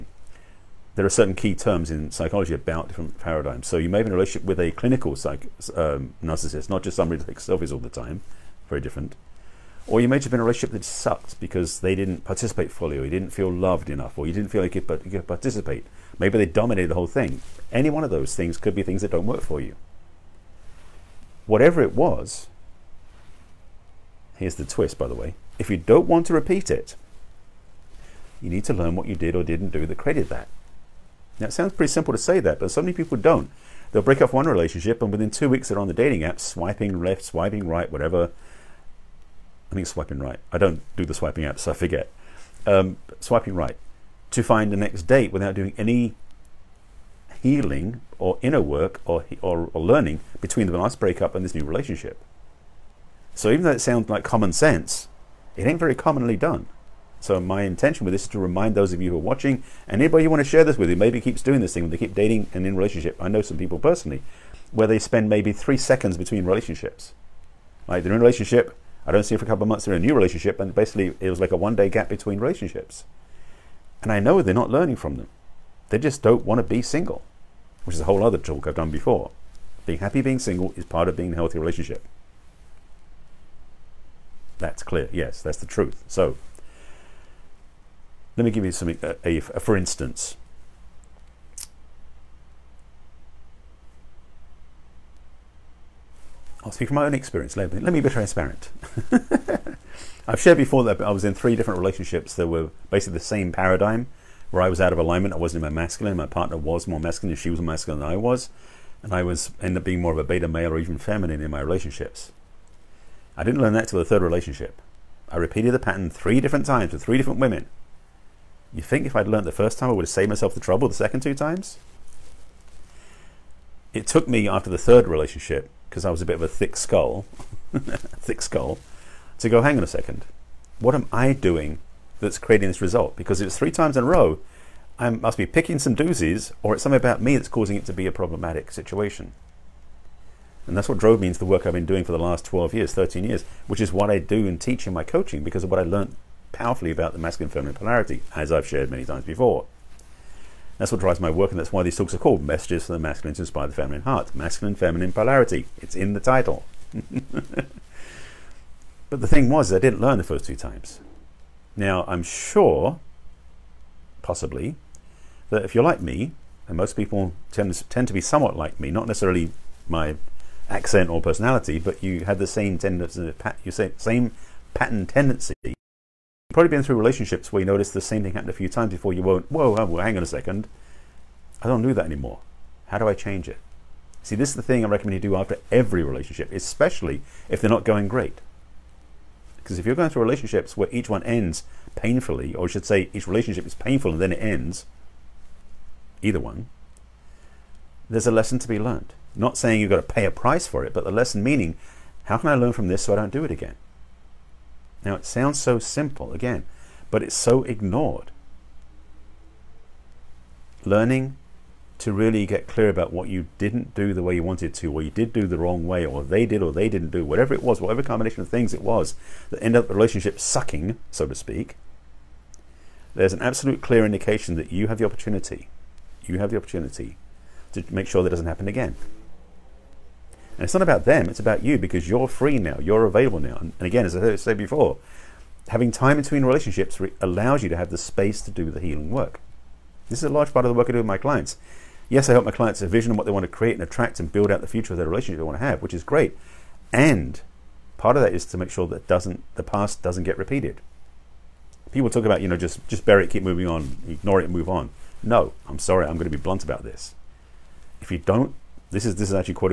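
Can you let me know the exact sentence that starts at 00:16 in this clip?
Maybe they dominated the whole thing.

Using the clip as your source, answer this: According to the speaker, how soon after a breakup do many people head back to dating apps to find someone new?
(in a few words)
within two weeks.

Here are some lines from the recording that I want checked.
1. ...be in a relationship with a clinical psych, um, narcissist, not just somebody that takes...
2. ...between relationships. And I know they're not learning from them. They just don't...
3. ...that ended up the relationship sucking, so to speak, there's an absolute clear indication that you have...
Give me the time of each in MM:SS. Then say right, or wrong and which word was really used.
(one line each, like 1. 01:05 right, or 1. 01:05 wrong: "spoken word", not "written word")
1. 00:04 right
2. 01:12 right
3. 03:39 right.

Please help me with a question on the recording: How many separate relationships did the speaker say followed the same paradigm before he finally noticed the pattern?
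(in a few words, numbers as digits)
3.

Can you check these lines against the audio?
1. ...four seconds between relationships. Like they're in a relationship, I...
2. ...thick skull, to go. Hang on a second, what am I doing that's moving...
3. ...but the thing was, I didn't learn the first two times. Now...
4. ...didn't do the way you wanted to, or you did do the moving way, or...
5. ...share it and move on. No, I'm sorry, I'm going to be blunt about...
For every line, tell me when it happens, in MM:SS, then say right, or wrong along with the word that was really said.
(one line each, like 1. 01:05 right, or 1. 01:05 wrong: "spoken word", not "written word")
1. 01:05 wrong: "three", not "four"
2. 02:07 wrong: "creating", not "moving"
3. 02:39 right
4. 03:33 wrong: "wrong", not "moving"
5. 04:14 wrong: "ignore", not "share".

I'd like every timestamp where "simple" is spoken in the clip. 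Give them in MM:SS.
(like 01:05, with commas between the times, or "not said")
00:31, 03:25.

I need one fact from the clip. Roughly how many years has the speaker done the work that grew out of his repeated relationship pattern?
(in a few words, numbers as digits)
13 years.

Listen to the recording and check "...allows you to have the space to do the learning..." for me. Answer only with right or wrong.
wrong.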